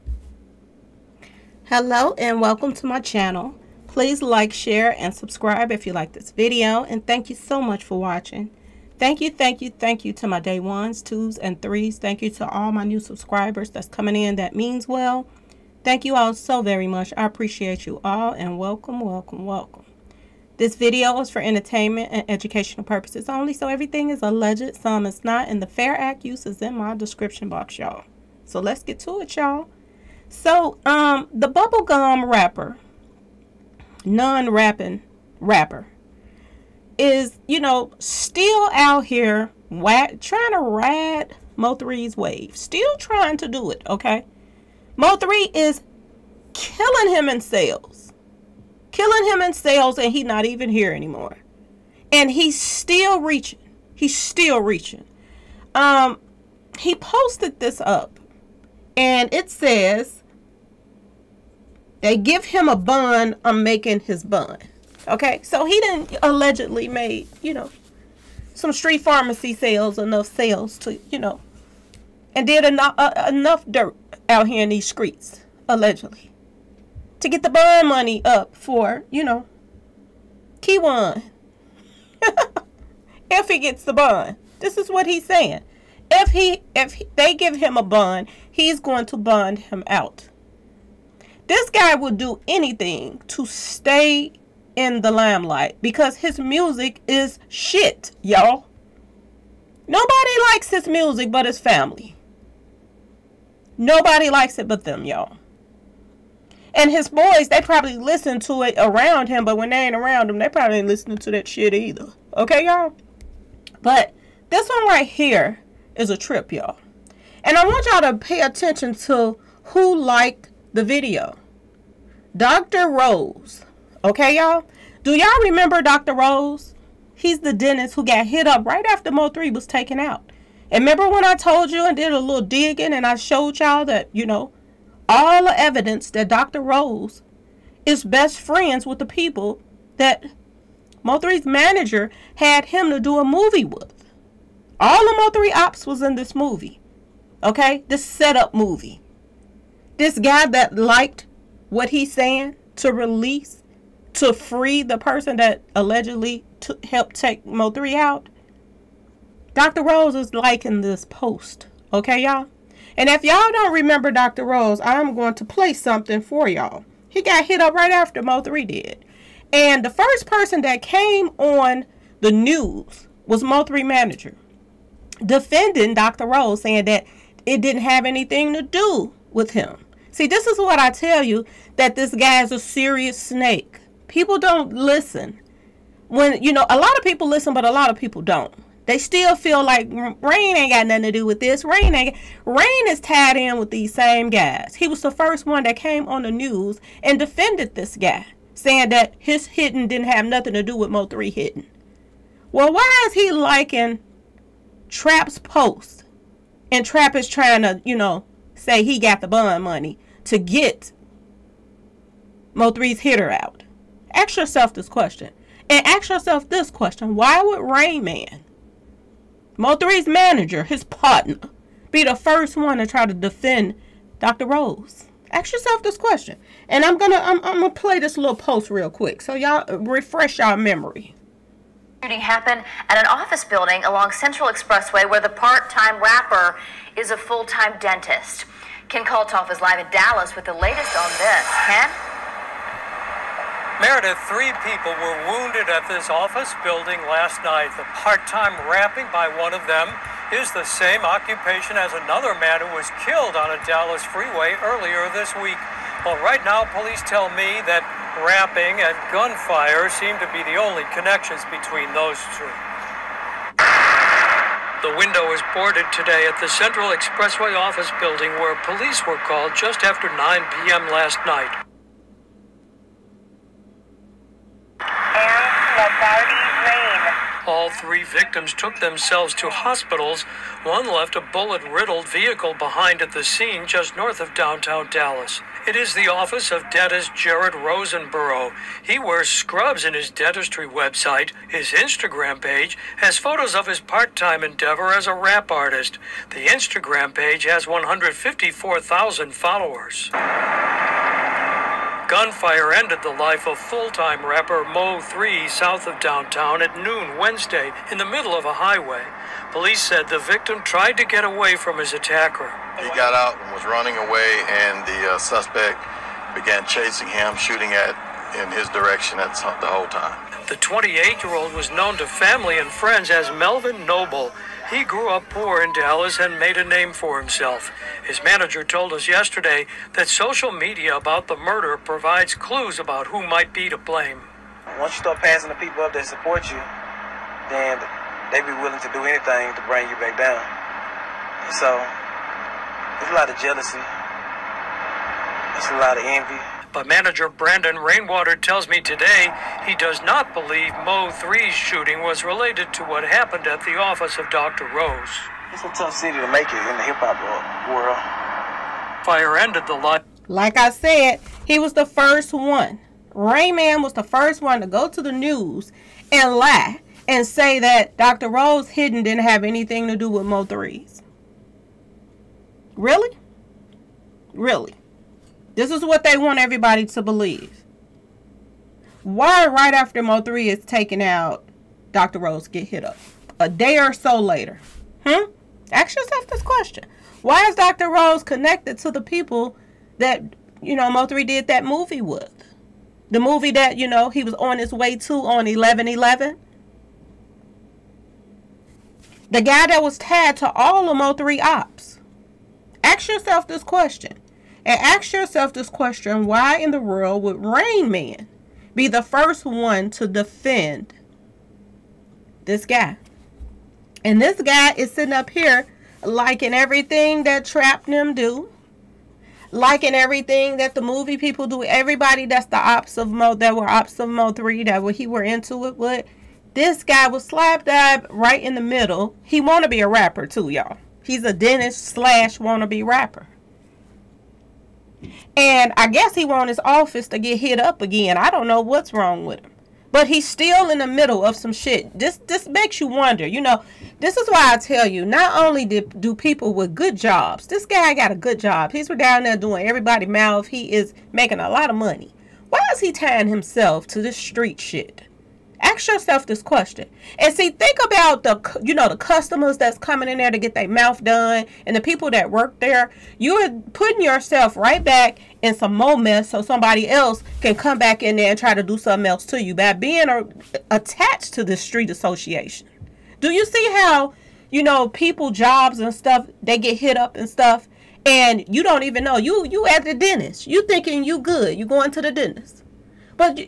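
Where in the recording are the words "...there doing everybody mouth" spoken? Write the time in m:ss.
7:29.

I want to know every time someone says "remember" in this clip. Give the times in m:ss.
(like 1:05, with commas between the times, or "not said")
2:05, 2:10, 2:43.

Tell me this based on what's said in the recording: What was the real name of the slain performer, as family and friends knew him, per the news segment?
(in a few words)
Melvin Noble.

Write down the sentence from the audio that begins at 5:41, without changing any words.
so, there's a lot of jealousy.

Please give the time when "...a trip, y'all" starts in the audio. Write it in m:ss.
1:56.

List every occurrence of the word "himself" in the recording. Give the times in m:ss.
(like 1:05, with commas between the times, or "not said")
5:27, 7:33.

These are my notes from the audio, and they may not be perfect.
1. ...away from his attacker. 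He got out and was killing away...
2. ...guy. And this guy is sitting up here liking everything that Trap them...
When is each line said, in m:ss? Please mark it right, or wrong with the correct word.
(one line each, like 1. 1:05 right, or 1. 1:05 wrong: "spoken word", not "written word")
1. 5:11 wrong: "running", not "killing"
2. 6:52 right.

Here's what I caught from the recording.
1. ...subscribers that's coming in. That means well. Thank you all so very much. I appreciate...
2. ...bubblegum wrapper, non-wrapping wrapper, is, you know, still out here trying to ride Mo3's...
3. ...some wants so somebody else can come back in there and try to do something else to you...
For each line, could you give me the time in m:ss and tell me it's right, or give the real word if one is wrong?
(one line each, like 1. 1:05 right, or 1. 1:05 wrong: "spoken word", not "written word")
1. 0:13 right
2. 0:31 right
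3. 7:45 wrong: "moments", not "wants".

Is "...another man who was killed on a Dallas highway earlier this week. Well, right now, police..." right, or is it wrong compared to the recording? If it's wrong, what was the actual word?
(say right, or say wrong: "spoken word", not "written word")
wrong: "freeway", not "highway".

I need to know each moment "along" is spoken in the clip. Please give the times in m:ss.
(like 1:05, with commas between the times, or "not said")
3:53.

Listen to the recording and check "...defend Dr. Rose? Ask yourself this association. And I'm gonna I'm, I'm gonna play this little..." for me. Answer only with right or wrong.
wrong.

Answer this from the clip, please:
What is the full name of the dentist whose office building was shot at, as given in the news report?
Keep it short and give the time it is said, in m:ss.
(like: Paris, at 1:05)
Jared Rosenborough, at 4:47.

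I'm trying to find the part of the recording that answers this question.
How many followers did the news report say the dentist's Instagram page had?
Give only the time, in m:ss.
4:57.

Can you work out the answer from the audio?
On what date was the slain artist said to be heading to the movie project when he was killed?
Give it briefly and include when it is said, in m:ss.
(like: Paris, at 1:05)
11-11, at 6:35.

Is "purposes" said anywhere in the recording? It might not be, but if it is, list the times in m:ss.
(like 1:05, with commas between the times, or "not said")
0:22.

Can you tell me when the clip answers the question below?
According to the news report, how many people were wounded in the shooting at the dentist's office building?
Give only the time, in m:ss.
4:04.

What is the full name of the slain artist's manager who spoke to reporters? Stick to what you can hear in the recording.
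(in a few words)
Brandon Rainwater.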